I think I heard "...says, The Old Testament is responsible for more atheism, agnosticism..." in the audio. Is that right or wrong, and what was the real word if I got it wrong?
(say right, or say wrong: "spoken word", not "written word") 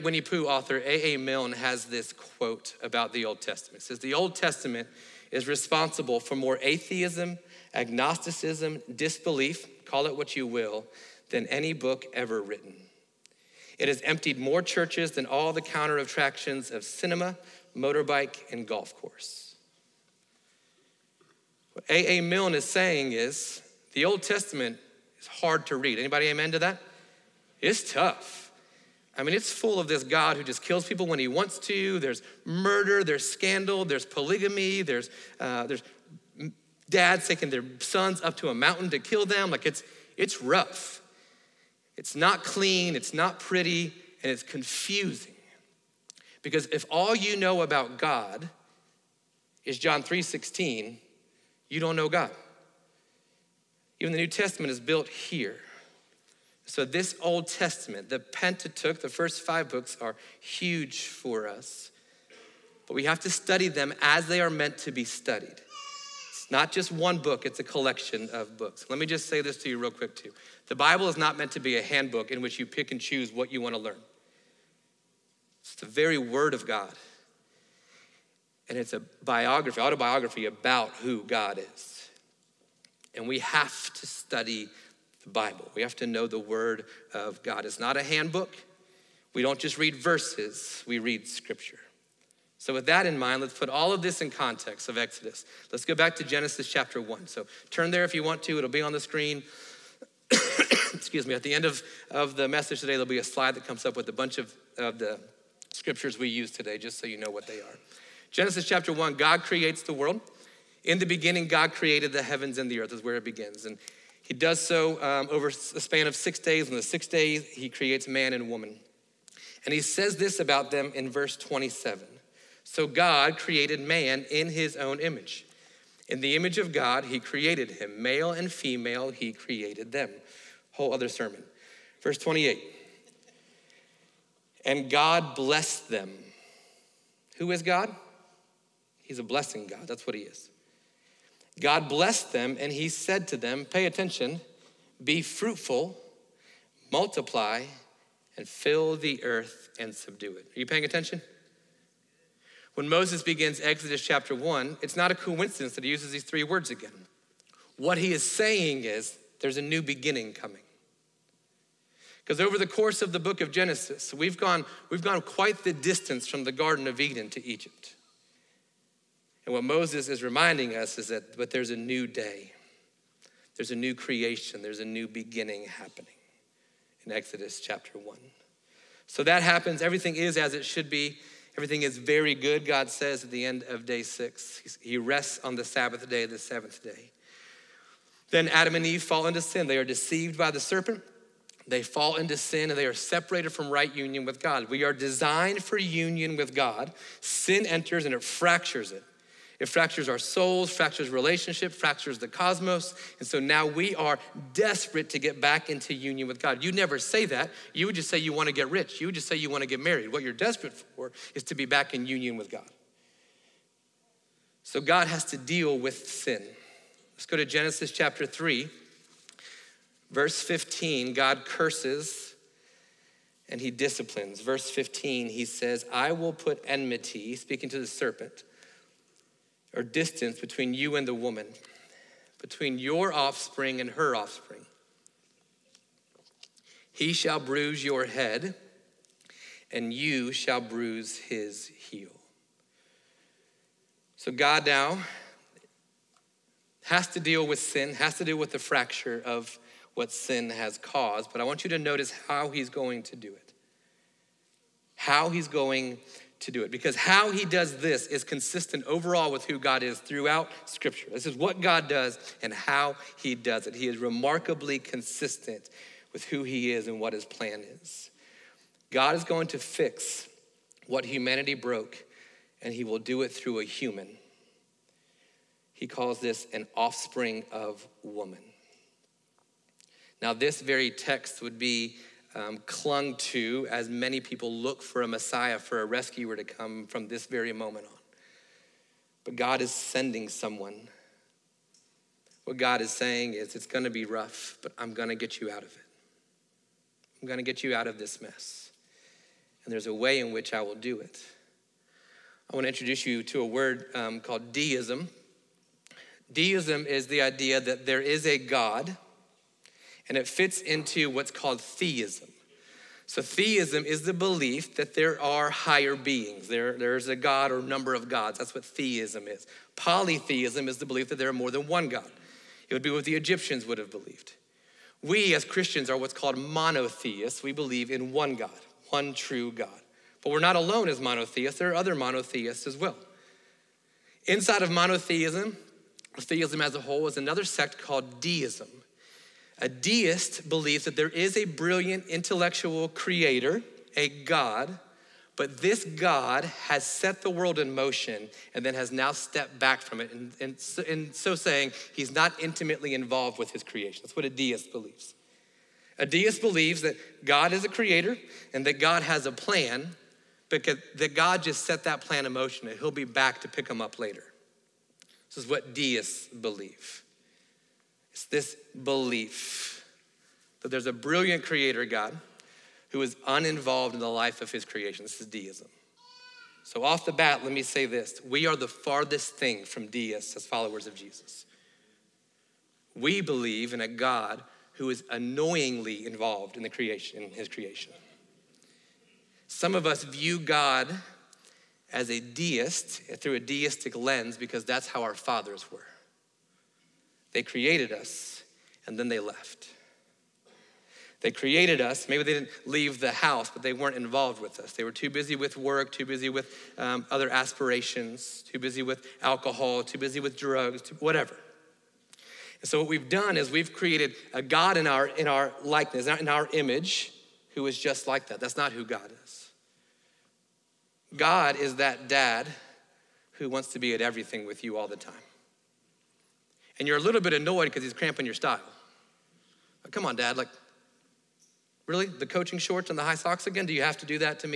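right.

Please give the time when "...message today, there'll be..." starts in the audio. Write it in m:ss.
1:42.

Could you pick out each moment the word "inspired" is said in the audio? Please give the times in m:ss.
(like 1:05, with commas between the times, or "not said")
not said.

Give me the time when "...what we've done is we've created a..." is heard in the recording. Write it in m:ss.
6:52.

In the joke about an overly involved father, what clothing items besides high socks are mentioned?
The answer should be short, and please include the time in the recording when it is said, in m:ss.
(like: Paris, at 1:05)
coaching shorts, at 7:12.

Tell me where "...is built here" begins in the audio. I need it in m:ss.
0:54.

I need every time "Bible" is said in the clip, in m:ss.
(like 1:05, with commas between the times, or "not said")
1:10, 1:25.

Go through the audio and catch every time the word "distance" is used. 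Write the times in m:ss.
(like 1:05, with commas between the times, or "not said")
2:45, 3:49.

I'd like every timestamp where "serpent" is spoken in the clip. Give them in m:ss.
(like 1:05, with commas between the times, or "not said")
3:10, 3:47.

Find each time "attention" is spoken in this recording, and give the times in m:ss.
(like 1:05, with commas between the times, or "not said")
2:23, 2:30.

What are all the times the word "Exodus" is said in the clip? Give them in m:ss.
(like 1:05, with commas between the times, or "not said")
1:34, 2:33, 2:57.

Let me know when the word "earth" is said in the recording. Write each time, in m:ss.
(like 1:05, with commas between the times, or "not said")
1:52, 2:29.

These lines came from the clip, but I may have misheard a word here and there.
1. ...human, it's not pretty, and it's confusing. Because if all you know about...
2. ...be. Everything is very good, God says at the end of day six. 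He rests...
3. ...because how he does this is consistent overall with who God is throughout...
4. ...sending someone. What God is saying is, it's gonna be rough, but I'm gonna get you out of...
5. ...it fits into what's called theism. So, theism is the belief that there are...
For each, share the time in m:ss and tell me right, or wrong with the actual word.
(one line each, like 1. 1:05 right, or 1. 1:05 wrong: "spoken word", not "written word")
1. 0:42 wrong: "clean", not "human"
2. 3:00 right
3. 4:16 right
4. 4:49 right
5. 5:10 right.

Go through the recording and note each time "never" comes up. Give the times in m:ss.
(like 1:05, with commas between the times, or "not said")
3:26.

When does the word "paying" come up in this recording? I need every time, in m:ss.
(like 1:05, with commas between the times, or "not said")
2:30.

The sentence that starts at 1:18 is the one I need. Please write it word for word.
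And it's a biography, autobiography about who God is.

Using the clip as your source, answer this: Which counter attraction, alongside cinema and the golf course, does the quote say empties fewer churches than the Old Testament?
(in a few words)
motorbike.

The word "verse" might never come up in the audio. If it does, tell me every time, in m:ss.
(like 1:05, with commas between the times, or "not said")
1:29, 2:01, 2:12, 3:40, 3:44.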